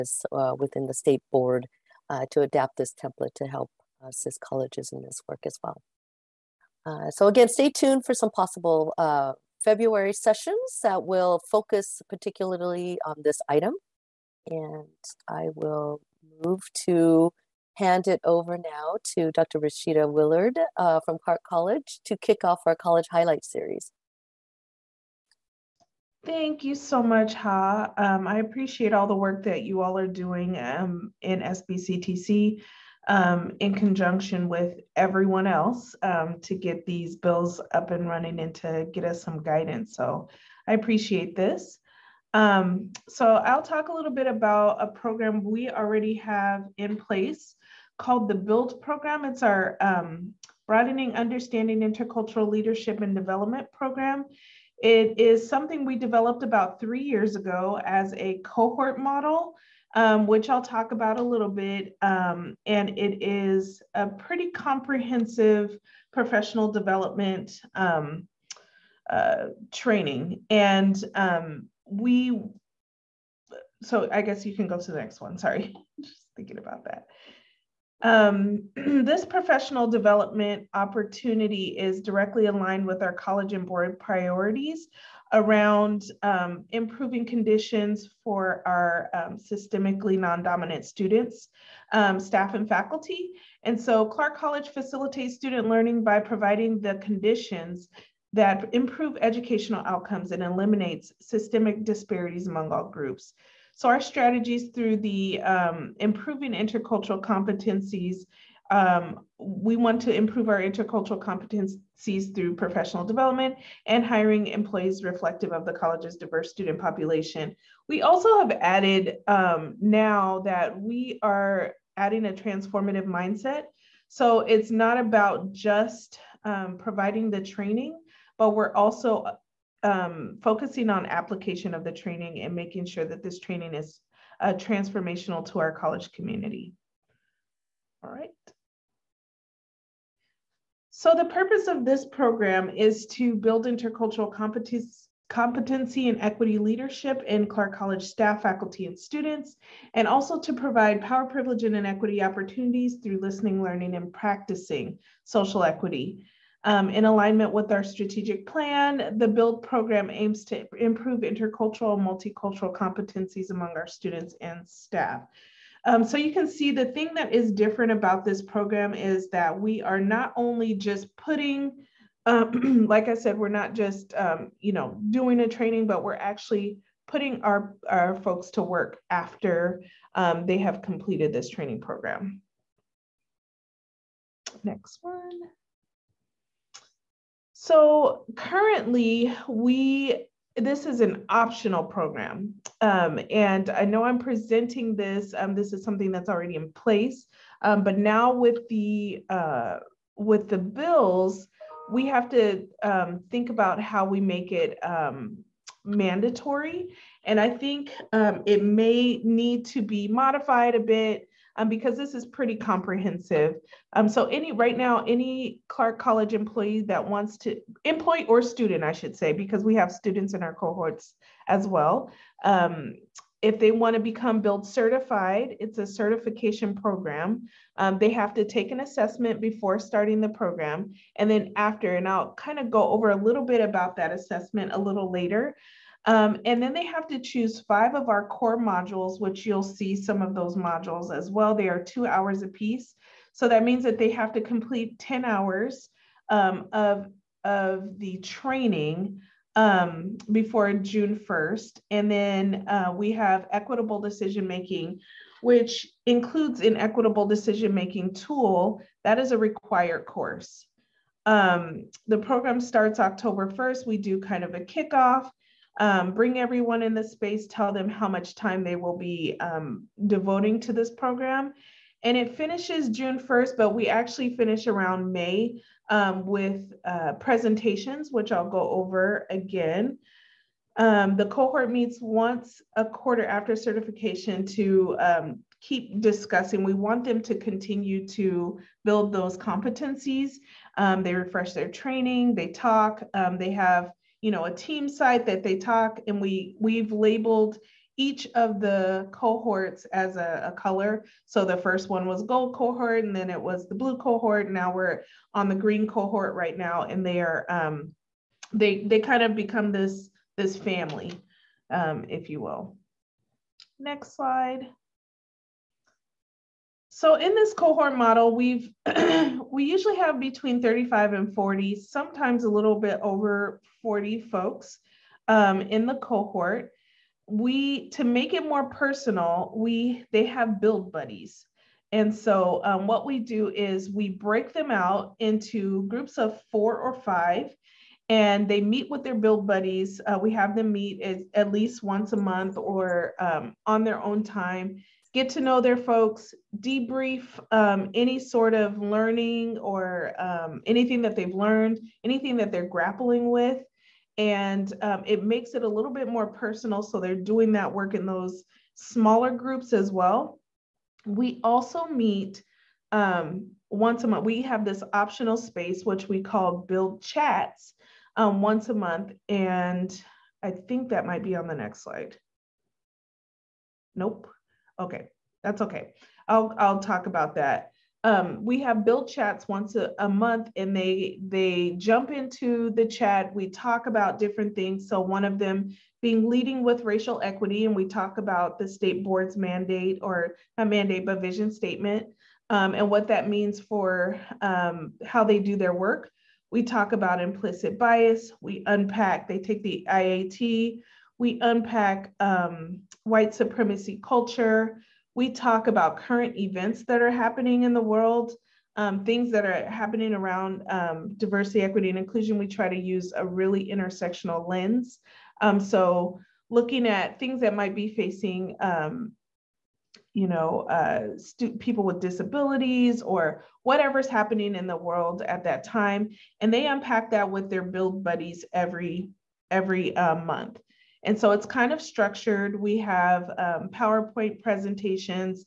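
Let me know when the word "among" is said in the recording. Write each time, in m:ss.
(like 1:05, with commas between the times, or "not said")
1:42, 2:43.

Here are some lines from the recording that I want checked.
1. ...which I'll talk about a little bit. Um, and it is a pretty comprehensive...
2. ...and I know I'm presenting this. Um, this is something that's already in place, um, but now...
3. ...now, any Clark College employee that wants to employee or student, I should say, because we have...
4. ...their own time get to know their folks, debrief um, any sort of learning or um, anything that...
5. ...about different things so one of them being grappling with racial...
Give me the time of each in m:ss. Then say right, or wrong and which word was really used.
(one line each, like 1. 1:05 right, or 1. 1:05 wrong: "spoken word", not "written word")
1. 1:00 right
2. 3:13 right
3. 3:34 right
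4. 5:43 right
5. 6:23 wrong: "leading", not "grappling".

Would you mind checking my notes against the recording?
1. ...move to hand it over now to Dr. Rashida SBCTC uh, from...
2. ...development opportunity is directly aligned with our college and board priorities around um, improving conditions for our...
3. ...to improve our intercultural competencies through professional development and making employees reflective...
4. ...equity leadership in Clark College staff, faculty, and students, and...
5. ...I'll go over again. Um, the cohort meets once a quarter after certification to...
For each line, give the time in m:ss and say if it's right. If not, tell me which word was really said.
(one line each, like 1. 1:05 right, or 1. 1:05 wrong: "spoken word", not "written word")
1. 0:16 wrong: "Willard", not "SBCTC"
2. 1:19 right
3. 1:50 wrong: "hiring", not "making"
4. 2:26 right
5. 4:38 right.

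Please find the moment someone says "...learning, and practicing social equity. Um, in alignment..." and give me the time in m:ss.
2:33.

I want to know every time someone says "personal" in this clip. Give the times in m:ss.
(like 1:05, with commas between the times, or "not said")
5:28, 5:56.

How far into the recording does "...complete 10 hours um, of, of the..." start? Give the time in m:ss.
4:04.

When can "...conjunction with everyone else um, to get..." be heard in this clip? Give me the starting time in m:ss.
0:33.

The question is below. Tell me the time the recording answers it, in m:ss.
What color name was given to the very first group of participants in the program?
5:02.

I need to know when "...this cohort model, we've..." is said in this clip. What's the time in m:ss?
5:17.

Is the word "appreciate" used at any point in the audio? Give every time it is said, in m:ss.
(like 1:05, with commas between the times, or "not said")
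0:28, 0:40.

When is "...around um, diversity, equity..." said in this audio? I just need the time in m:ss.
6:50.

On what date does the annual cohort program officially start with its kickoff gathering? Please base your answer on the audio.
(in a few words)
October 1.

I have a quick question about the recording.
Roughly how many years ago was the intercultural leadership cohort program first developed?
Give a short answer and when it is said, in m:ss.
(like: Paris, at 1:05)
3 years, at 0:56.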